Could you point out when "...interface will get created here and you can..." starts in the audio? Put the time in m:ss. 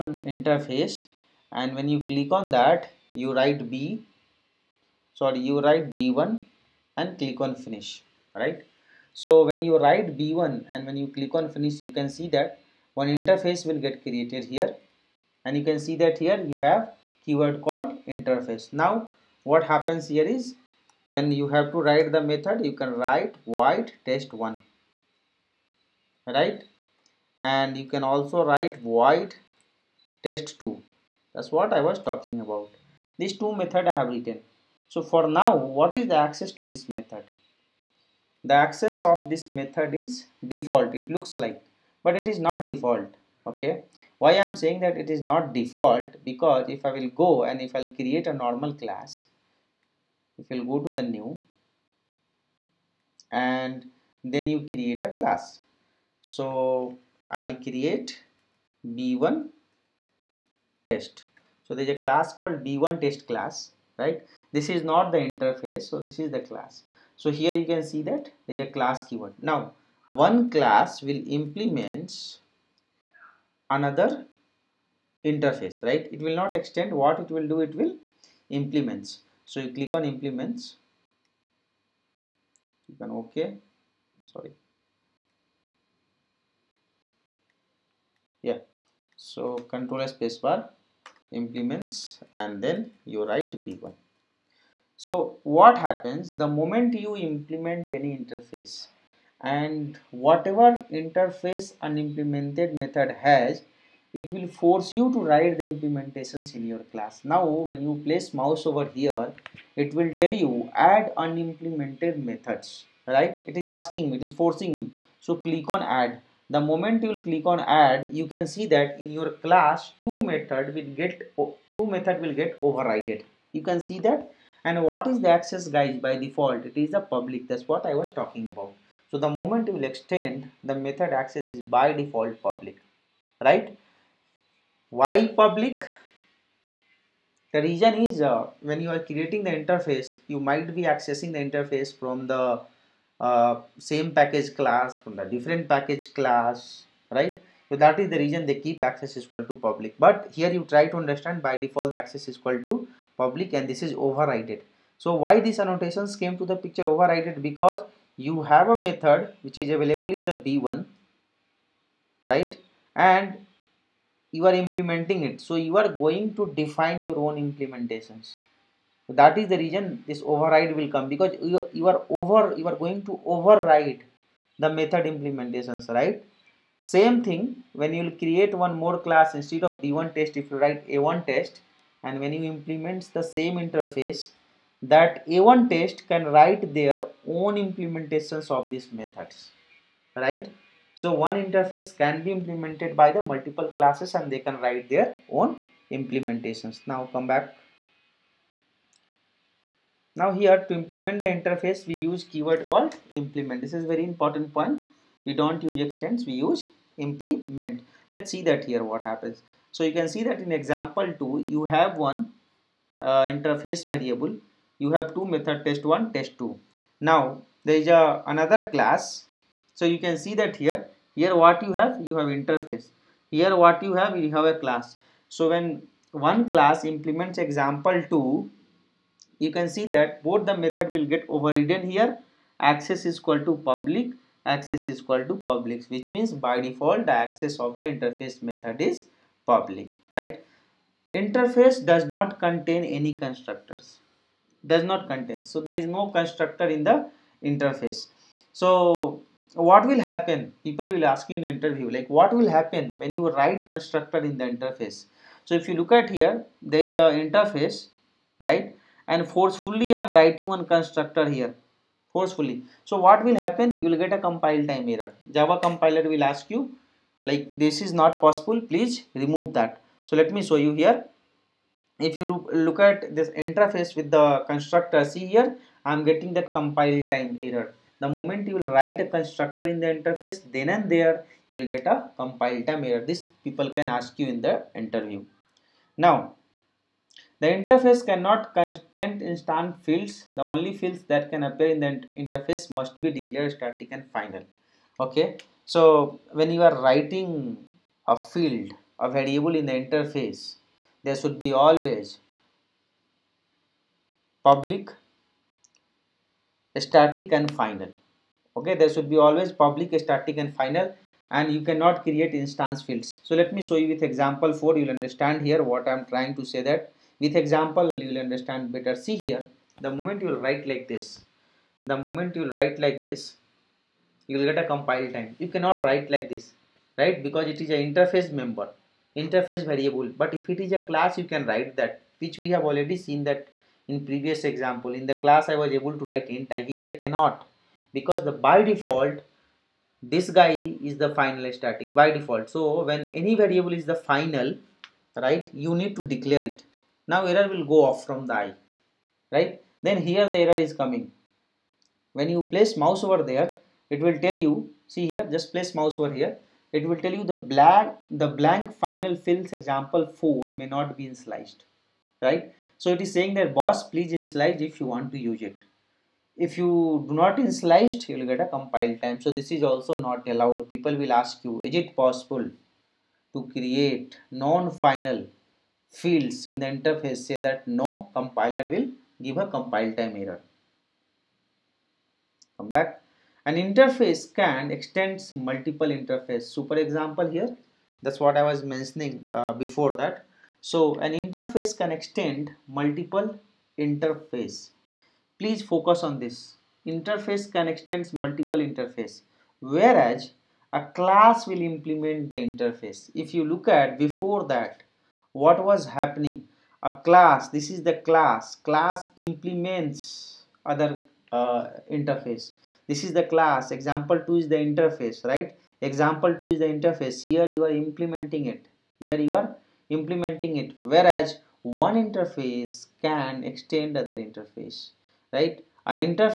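0:13.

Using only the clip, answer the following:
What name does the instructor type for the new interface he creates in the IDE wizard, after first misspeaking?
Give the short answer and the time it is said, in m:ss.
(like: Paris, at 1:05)
B1, at 0:05.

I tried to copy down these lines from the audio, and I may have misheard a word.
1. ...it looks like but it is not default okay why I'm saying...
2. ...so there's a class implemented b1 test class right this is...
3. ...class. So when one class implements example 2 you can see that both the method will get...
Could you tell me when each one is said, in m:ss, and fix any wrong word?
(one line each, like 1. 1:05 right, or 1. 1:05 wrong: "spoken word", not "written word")
1. 0:40 right
2. 1:01 wrong: "called", not "implemented"
3. 3:44 right.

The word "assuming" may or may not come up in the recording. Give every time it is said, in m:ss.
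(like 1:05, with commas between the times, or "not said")
not said.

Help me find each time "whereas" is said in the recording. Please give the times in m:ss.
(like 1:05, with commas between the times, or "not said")
6:39, 7:00.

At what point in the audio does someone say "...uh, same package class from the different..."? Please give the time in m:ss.
2:23.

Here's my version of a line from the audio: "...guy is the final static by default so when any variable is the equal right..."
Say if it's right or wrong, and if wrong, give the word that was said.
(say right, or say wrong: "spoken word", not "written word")
wrong: "final", not "equal".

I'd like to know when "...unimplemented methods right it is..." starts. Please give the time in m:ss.
1:51.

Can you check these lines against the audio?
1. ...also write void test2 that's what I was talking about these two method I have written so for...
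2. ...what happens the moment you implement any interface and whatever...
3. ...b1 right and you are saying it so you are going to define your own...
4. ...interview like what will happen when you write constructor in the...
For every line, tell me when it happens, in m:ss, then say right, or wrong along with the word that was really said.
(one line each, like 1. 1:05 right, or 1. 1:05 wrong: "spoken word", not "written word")
1. 0:28 right
2. 1:35 right
3. 2:40 wrong: "implementing", not "saying"
4. 4:11 right.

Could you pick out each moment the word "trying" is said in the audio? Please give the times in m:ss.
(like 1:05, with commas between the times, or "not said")
5:16.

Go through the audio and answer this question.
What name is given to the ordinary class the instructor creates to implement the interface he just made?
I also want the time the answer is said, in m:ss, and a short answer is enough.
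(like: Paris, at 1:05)
b1 test, at 0:57.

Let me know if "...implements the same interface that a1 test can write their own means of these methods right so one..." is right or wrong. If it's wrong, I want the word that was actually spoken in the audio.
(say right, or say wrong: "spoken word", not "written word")
wrong: "implementations", not "means".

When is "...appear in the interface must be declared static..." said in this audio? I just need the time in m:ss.
4:51.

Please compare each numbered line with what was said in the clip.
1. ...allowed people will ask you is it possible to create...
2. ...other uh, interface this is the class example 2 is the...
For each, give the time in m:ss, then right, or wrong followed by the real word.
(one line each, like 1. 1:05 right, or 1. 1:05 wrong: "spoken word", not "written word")
1. 6:10 right
2. 6:50 right.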